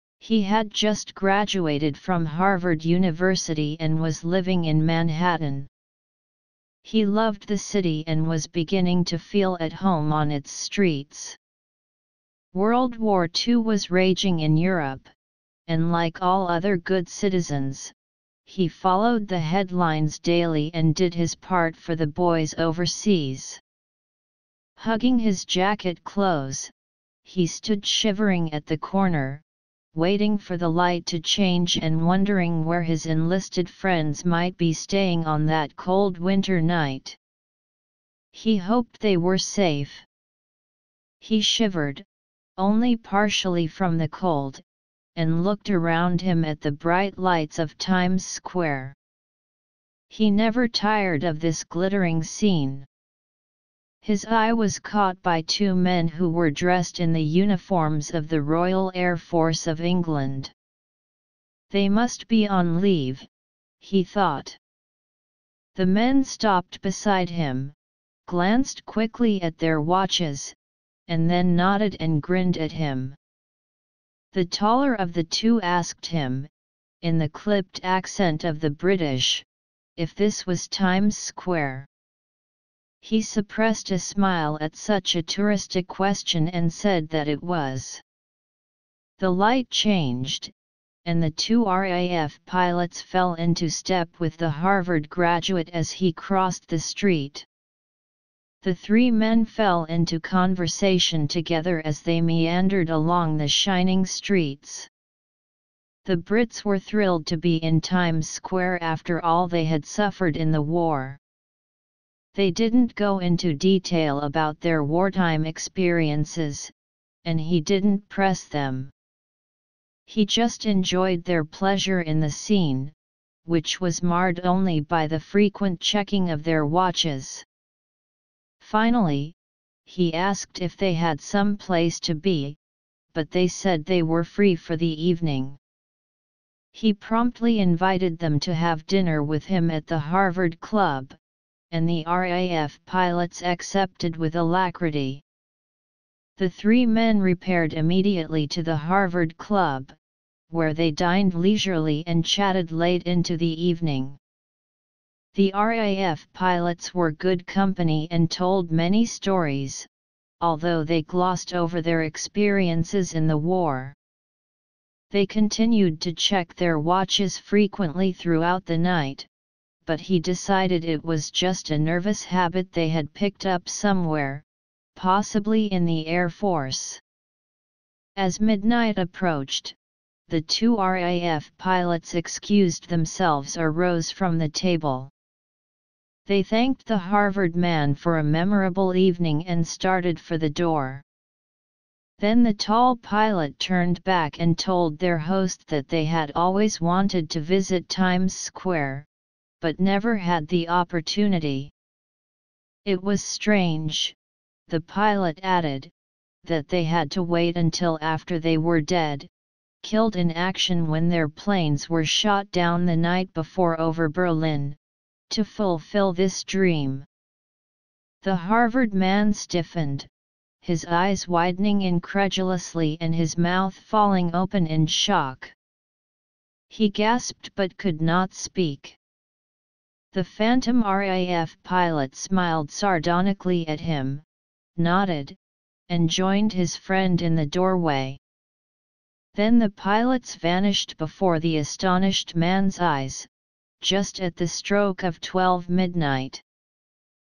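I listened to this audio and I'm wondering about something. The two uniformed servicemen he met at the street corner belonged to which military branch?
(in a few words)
Royal Air Force.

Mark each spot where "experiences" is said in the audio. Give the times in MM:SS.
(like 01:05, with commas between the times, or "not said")
01:55, 02:42.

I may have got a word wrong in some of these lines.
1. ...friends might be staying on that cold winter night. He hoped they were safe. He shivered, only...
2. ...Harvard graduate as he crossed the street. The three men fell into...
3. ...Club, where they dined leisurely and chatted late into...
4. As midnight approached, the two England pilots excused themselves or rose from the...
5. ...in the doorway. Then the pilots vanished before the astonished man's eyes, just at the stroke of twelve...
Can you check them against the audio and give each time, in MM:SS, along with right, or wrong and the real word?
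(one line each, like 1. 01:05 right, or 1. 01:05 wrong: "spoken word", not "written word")
1. 00:33 right
2. 01:34 right
3. 02:29 right
4. 02:58 wrong: "RAF", not "England"
5. 03:57 right.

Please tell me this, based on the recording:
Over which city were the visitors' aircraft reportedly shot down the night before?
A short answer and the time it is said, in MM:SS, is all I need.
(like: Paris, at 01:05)
Berlin, at 03:34.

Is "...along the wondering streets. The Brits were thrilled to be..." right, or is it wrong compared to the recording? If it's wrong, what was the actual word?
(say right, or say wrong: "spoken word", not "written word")
wrong: "shining", not "wondering".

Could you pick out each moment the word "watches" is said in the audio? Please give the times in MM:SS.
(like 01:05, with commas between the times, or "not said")
01:09, 02:06, 02:46.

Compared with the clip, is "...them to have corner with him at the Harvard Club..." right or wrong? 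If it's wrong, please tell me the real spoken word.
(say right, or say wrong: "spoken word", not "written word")
wrong: "dinner", not "corner".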